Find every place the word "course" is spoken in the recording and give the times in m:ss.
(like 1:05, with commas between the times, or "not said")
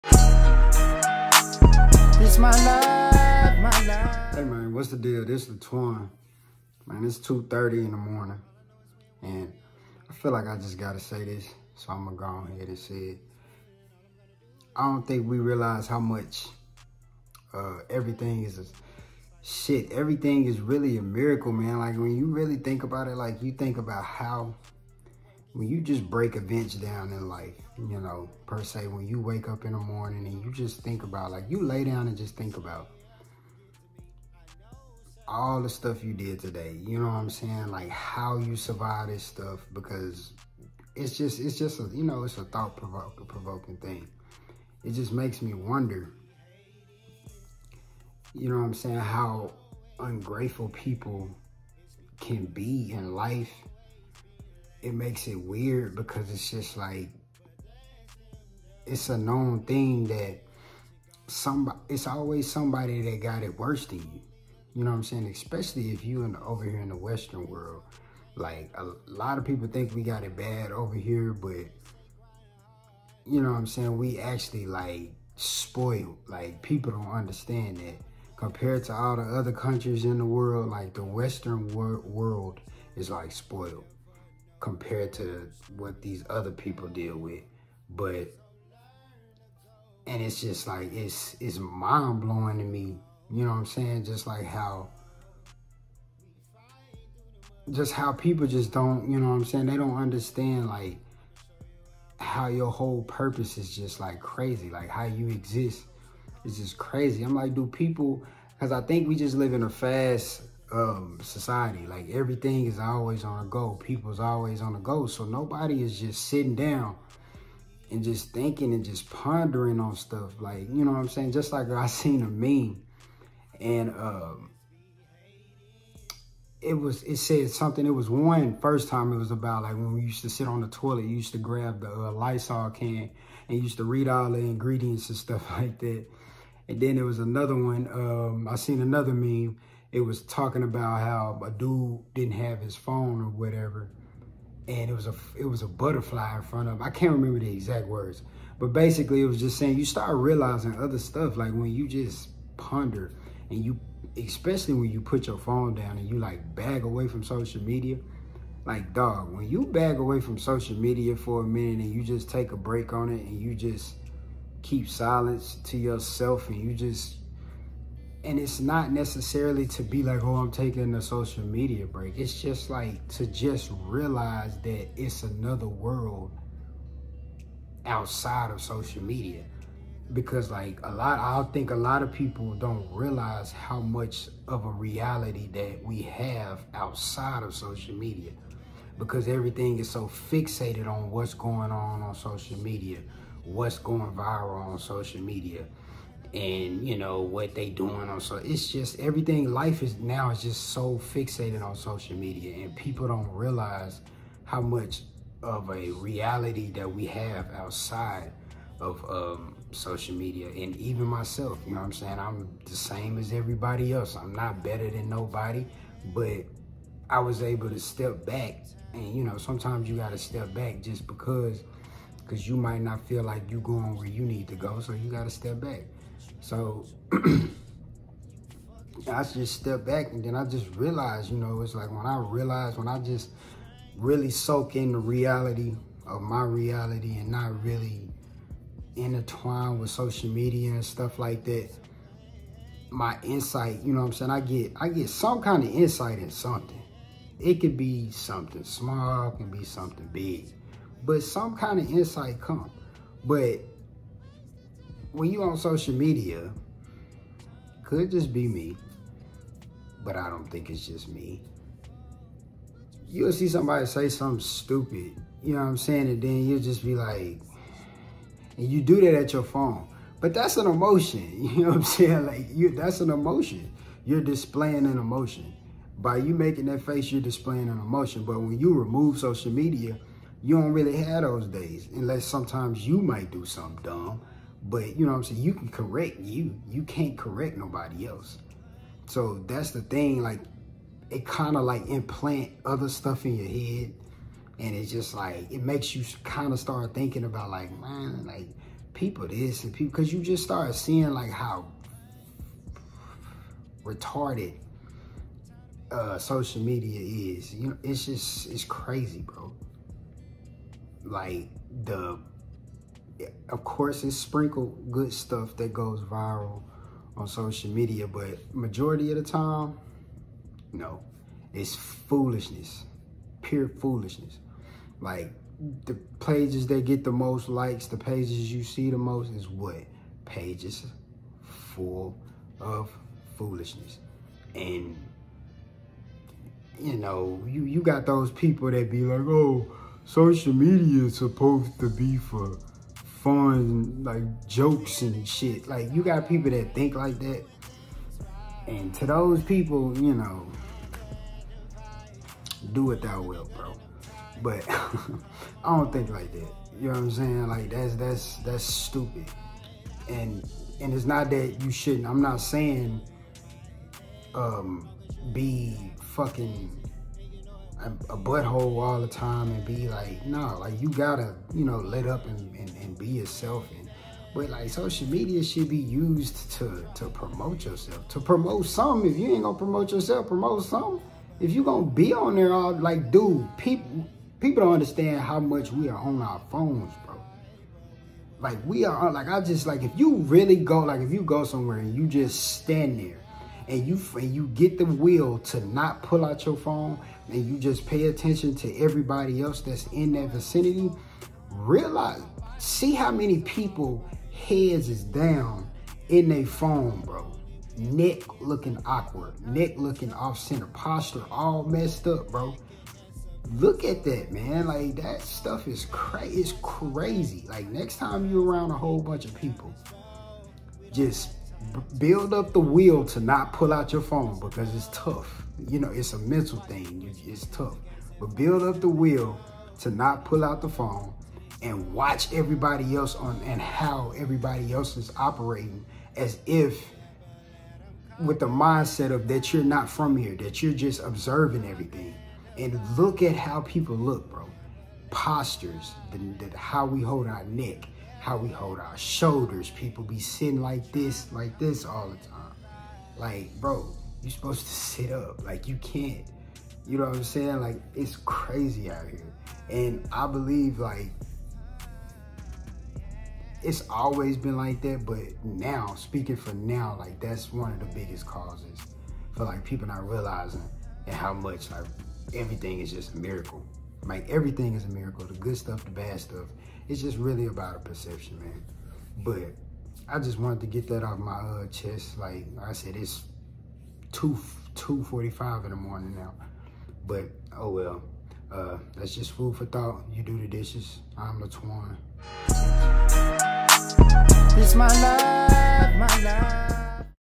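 5:13.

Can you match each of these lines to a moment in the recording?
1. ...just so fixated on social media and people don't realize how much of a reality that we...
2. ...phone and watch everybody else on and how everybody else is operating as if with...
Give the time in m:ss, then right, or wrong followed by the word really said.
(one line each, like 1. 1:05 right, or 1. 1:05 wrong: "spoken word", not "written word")
1. 3:20 right
2. 7:10 right.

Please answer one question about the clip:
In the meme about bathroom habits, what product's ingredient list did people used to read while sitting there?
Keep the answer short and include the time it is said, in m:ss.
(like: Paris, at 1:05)
Lysol, at 2:12.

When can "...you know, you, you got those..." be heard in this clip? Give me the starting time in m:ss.
5:36.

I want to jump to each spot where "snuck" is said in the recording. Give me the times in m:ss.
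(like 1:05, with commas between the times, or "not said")
not said.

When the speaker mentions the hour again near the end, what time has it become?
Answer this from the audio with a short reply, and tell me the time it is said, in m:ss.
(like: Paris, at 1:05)
2:45 in the morning, at 8:04.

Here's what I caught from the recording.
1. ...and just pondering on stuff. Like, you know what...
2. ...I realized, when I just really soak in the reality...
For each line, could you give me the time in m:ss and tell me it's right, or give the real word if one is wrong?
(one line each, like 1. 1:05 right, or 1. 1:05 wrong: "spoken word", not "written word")
1. 1:58 right
2. 3:52 right.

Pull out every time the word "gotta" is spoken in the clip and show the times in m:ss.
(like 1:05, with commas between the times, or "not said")
0:10, 6:10.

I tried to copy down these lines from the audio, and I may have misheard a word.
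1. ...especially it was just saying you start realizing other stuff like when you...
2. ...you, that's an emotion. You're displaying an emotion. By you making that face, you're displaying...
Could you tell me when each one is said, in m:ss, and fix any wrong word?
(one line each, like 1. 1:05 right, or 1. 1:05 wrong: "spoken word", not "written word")
1. 2:28 wrong: "basically", not "especially"
2. 4:32 right.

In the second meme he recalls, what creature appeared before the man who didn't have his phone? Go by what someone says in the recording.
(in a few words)
a butterfly.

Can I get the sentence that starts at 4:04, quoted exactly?
I get I get some kind of insight in something.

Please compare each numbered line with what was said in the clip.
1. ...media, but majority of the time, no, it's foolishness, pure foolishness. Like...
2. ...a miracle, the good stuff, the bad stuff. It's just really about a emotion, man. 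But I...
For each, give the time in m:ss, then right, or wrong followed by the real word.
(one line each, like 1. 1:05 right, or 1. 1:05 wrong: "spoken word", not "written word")
1. 5:17 right
2. 7:54 wrong: "perception", not "emotion".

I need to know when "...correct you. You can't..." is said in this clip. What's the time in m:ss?
4:45.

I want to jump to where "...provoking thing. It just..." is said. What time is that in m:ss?
0:43.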